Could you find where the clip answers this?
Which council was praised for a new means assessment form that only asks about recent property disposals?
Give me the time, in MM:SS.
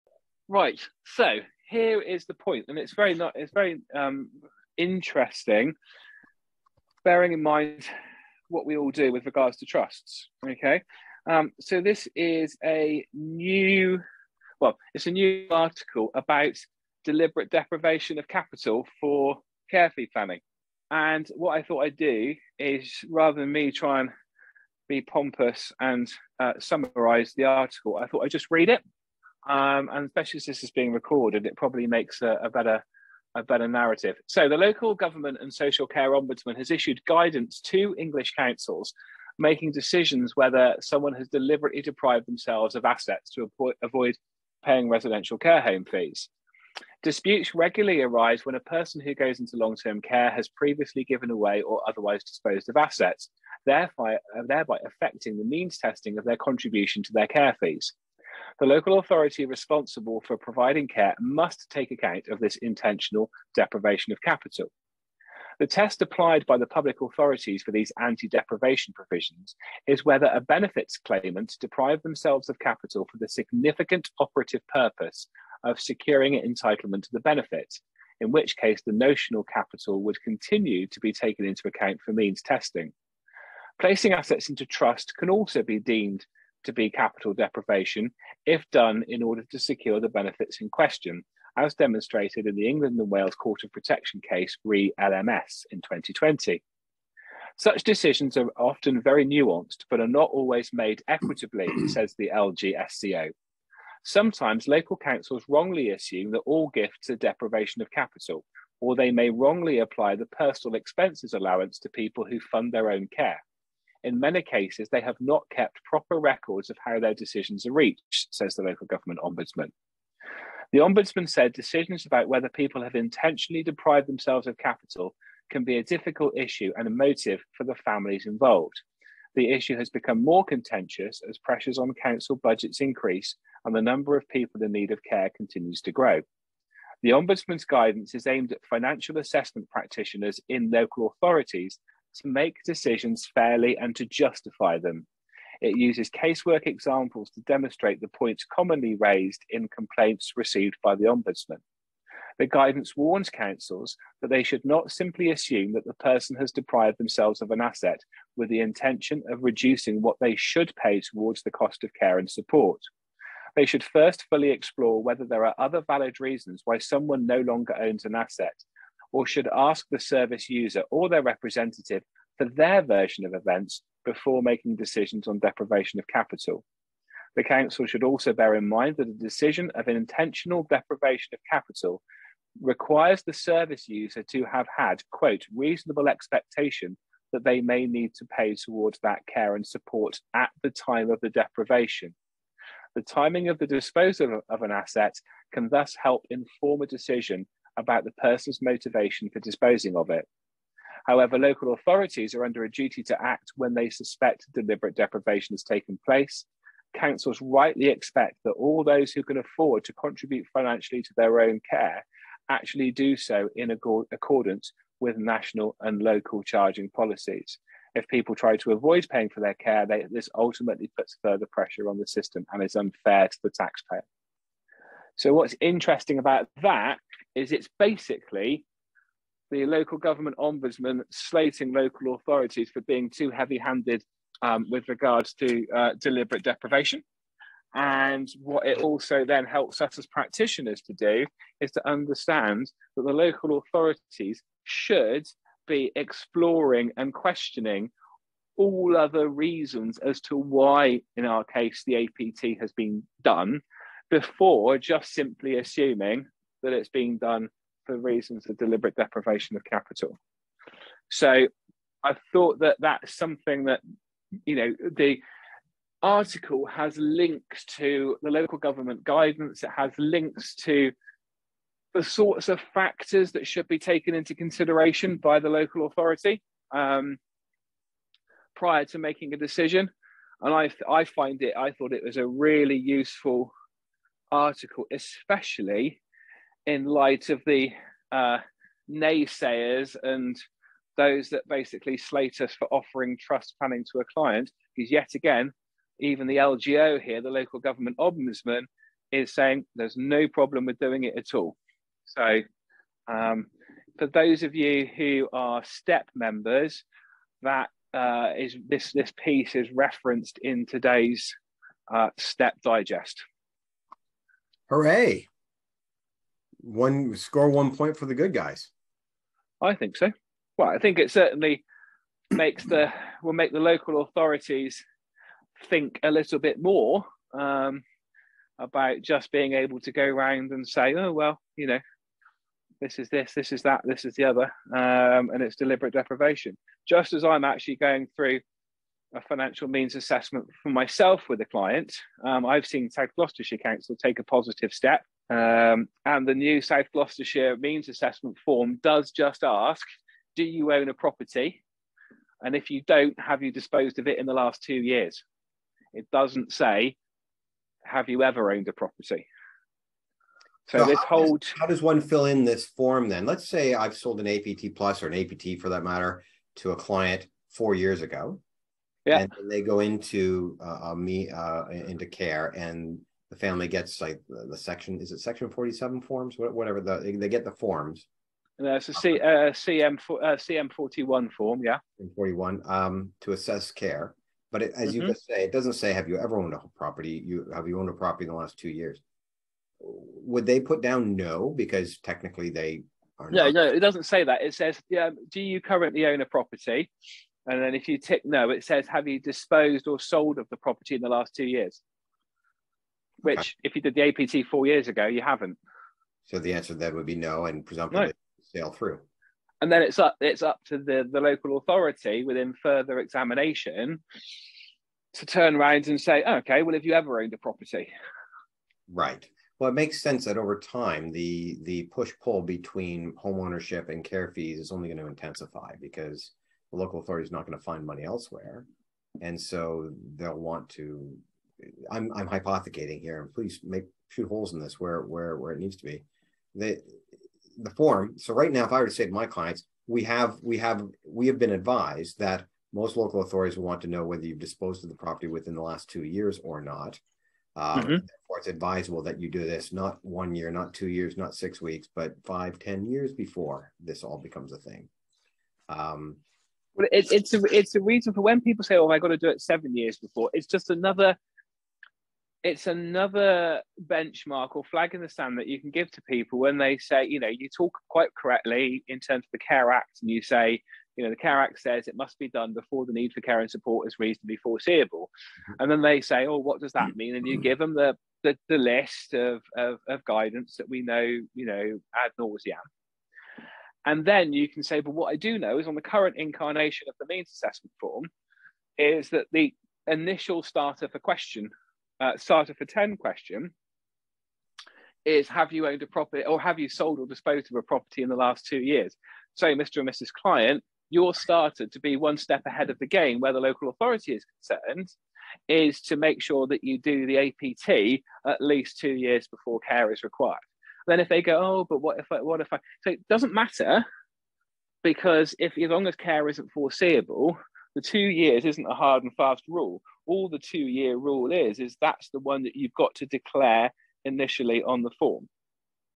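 05:42.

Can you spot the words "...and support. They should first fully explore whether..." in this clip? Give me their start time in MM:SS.
02:42.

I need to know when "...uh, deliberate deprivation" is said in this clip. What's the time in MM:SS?
03:55.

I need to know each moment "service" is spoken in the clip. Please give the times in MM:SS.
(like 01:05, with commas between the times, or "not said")
02:49, 03:03.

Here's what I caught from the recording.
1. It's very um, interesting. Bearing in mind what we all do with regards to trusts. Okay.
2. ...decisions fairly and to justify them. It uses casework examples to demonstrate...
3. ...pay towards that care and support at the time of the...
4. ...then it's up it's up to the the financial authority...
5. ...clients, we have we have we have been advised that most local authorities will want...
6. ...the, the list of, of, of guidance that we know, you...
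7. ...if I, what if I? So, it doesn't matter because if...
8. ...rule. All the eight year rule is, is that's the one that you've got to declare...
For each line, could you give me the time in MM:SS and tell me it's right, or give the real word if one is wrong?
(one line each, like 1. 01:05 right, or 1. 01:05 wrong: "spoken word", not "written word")
1. 00:03 right
2. 02:22 right
3. 03:08 right
4. 06:49 wrong: "local", not "financial"
5. 07:19 right
6. 07:58 right
7. 08:31 right
8. 08:39 wrong: "two", not "eight".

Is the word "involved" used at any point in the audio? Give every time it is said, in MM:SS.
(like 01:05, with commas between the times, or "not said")
02:08.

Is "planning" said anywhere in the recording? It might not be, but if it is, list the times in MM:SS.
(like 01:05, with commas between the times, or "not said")
00:20, 04:53.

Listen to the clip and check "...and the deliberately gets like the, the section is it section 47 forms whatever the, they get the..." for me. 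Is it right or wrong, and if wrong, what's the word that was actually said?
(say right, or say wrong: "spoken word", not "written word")
wrong: "family", not "deliberately".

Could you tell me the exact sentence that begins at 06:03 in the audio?
Let's say I've sold an APT plus or an APT for that matter to a client four years ago.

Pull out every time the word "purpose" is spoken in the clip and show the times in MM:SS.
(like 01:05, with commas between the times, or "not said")
01:14.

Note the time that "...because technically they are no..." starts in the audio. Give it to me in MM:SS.
06:31.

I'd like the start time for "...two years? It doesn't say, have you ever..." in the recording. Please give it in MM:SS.
05:54.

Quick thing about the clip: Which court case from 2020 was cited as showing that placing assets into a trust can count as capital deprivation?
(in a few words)
Re LMS.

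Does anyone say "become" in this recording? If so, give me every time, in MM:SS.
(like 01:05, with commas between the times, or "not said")
02:09, 07:34.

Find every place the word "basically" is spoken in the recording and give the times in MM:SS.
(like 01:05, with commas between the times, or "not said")
03:47, 04:51.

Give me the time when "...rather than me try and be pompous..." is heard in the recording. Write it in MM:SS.
00:23.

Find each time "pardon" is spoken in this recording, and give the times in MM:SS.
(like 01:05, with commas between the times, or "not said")
not said.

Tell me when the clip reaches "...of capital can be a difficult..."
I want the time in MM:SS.
02:04.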